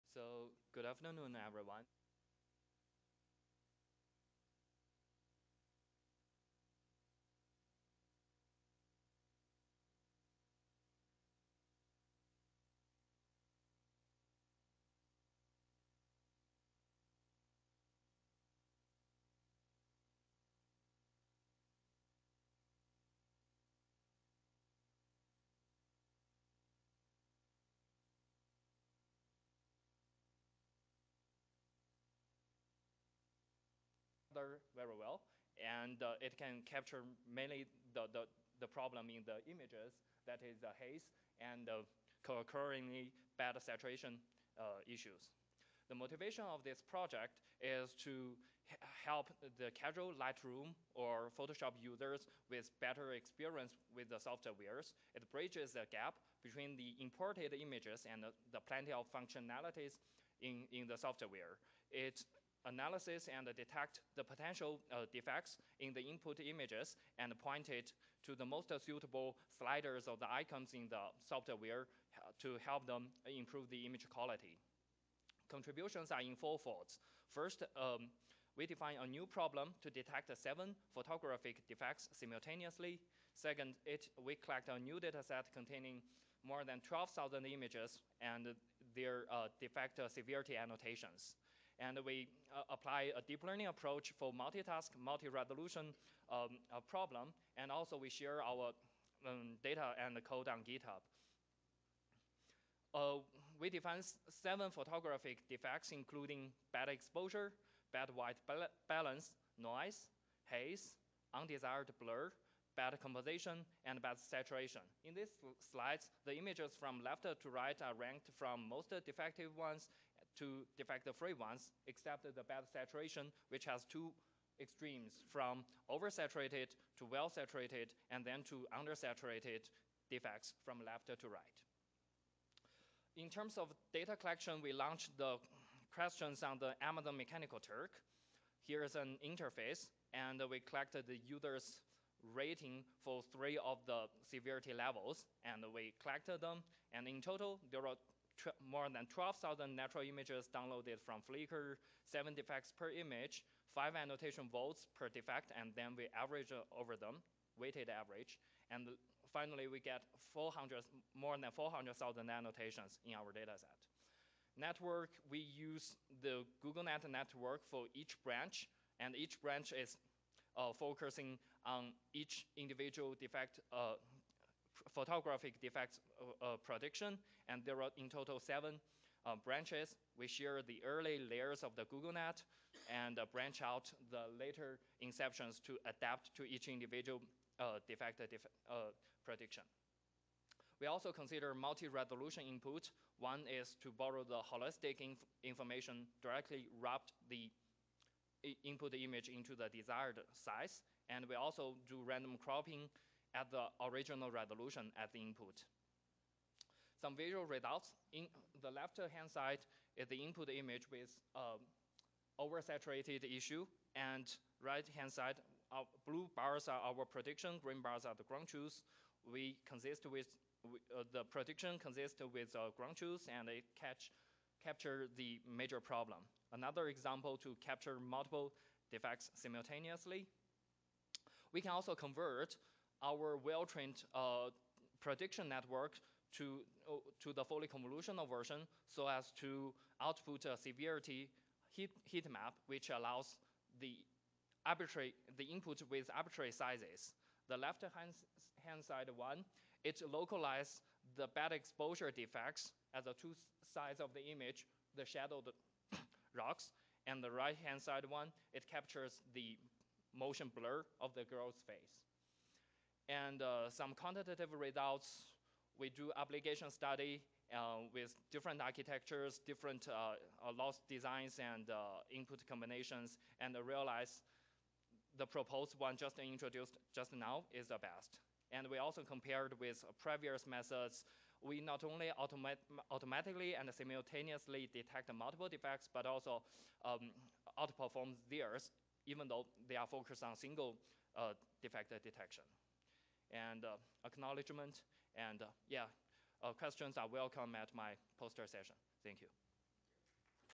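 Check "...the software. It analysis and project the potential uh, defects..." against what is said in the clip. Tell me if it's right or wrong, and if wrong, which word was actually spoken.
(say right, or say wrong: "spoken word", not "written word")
wrong: "detect", not "project".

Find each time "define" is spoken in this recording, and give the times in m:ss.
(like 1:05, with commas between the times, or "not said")
1:18, 1:43.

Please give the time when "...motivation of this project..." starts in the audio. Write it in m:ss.
0:45.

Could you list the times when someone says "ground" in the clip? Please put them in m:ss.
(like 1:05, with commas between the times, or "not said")
3:38, 3:42.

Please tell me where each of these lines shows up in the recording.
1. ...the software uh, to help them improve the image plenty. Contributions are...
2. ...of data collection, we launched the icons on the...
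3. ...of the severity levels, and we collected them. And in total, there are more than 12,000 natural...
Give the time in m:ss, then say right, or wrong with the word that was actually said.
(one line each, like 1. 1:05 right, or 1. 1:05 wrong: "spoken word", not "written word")
1. 1:10 wrong: "quality", not "plenty"
2. 2:13 wrong: "questions", not "icons"
3. 2:23 right.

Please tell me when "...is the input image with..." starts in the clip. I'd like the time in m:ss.
3:29.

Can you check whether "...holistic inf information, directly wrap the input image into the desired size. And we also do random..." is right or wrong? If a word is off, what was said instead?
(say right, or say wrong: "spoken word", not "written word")
right.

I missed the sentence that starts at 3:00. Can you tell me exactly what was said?
We share the early layers of the GoogleNet and branch out the later inceptions to adapt to each individual defect def prediction.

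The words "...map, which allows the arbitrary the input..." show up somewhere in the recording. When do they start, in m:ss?
4:02.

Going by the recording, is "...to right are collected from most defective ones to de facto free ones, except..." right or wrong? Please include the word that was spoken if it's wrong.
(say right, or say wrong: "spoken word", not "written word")
wrong: "ranked", not "collected".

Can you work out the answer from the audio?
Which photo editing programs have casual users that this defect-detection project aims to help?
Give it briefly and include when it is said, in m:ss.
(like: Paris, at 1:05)
Lightroom or Photoshop, at 0:50.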